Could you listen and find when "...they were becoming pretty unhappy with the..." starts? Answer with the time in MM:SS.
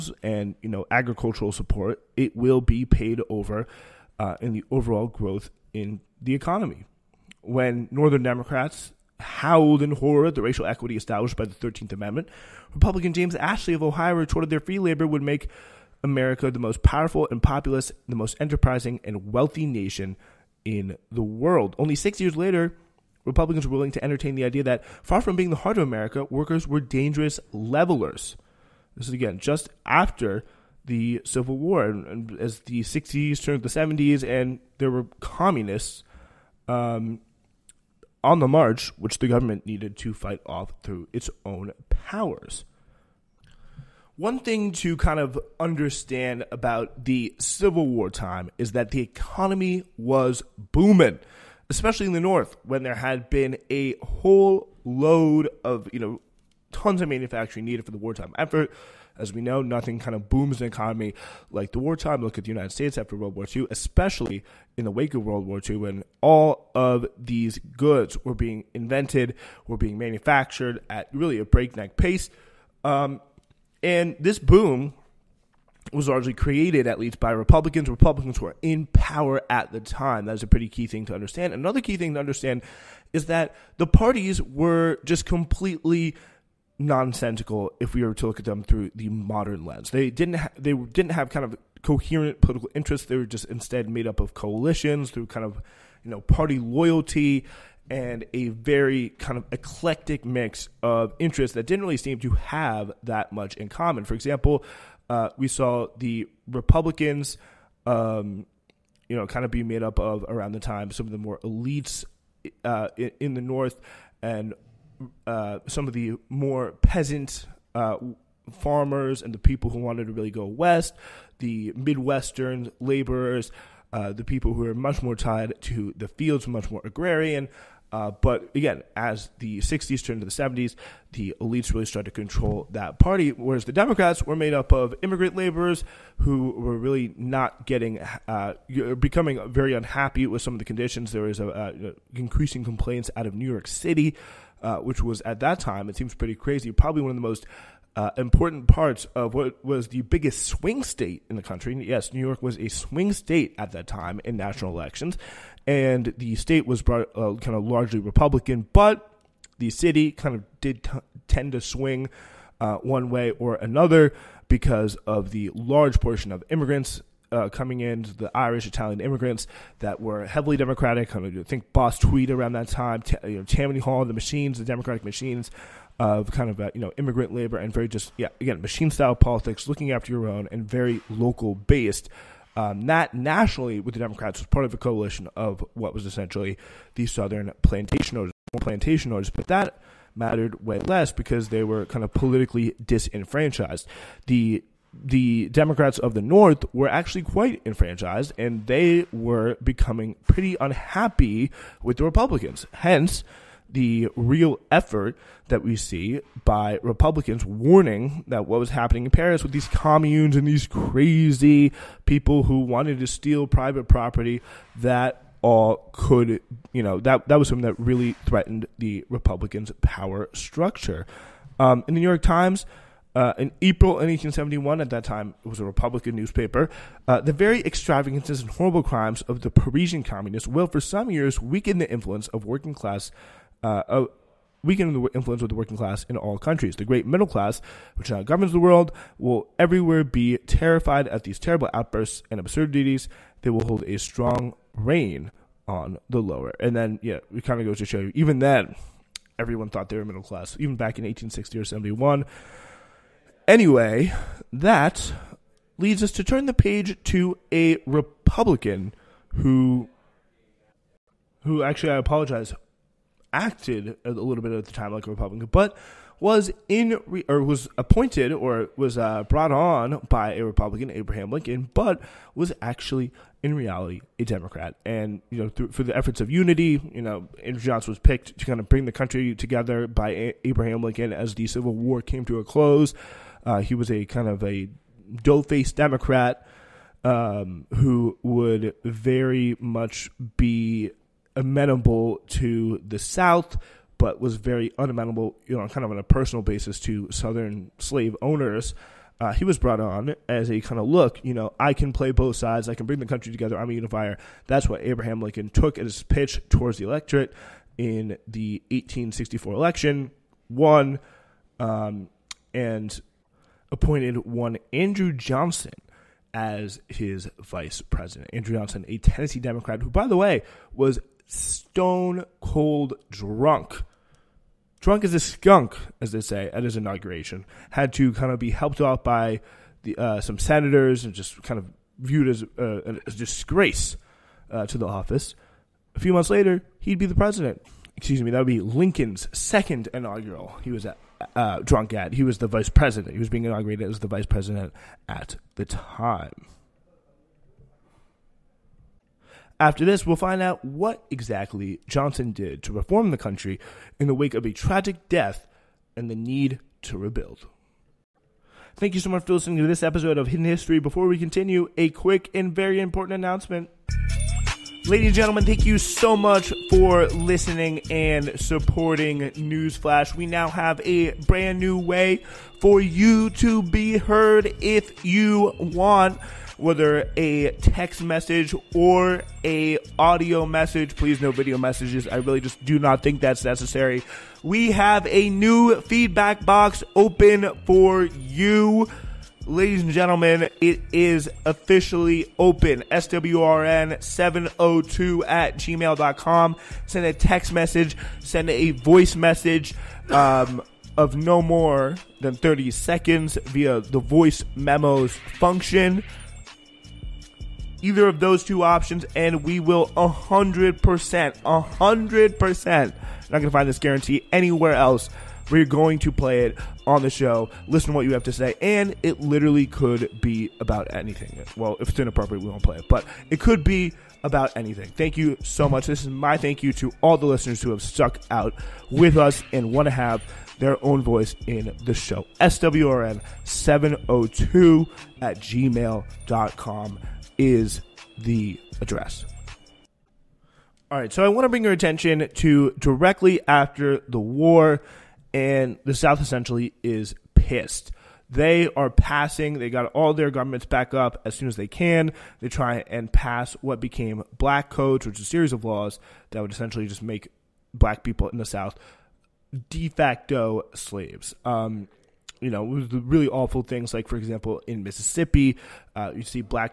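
03:18.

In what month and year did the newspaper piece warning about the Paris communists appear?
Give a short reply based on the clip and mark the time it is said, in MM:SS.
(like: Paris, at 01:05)
April 1871, at 03:43.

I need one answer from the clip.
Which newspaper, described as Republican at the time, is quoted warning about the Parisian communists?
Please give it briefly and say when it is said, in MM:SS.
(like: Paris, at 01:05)
The New York Times, at 03:42.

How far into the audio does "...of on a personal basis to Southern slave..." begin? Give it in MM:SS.
04:55.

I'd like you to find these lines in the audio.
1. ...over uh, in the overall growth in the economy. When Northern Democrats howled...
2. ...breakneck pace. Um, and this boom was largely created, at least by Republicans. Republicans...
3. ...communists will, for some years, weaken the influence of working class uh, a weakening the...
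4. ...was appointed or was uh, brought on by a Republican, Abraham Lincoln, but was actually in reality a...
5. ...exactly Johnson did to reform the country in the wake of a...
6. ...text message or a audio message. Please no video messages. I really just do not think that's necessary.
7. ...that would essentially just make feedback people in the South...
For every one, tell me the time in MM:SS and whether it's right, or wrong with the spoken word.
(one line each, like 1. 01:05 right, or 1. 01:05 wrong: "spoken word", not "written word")
1. 00:03 right
2. 01:11 right
3. 03:50 right
4. 04:27 right
5. 05:51 right
6. 06:17 right
7. 07:36 wrong: "black", not "feedback".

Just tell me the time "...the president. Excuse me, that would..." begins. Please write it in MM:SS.
05:37.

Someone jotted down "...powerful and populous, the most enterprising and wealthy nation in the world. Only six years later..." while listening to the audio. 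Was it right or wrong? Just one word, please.
right.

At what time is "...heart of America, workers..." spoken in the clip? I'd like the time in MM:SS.
00:25.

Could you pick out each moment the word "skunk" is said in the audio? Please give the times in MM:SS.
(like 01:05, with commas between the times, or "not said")
05:25.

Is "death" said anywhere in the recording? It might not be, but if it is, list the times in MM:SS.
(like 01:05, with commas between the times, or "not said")
05:55.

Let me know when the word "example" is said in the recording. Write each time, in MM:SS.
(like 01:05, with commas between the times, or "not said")
01:44, 07:44.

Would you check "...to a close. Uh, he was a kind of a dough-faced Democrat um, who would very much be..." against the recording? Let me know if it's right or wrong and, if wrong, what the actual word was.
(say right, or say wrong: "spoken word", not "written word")
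right.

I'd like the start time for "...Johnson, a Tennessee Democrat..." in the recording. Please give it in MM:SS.
05:18.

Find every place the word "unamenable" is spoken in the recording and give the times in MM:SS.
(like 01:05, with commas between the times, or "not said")
04:54.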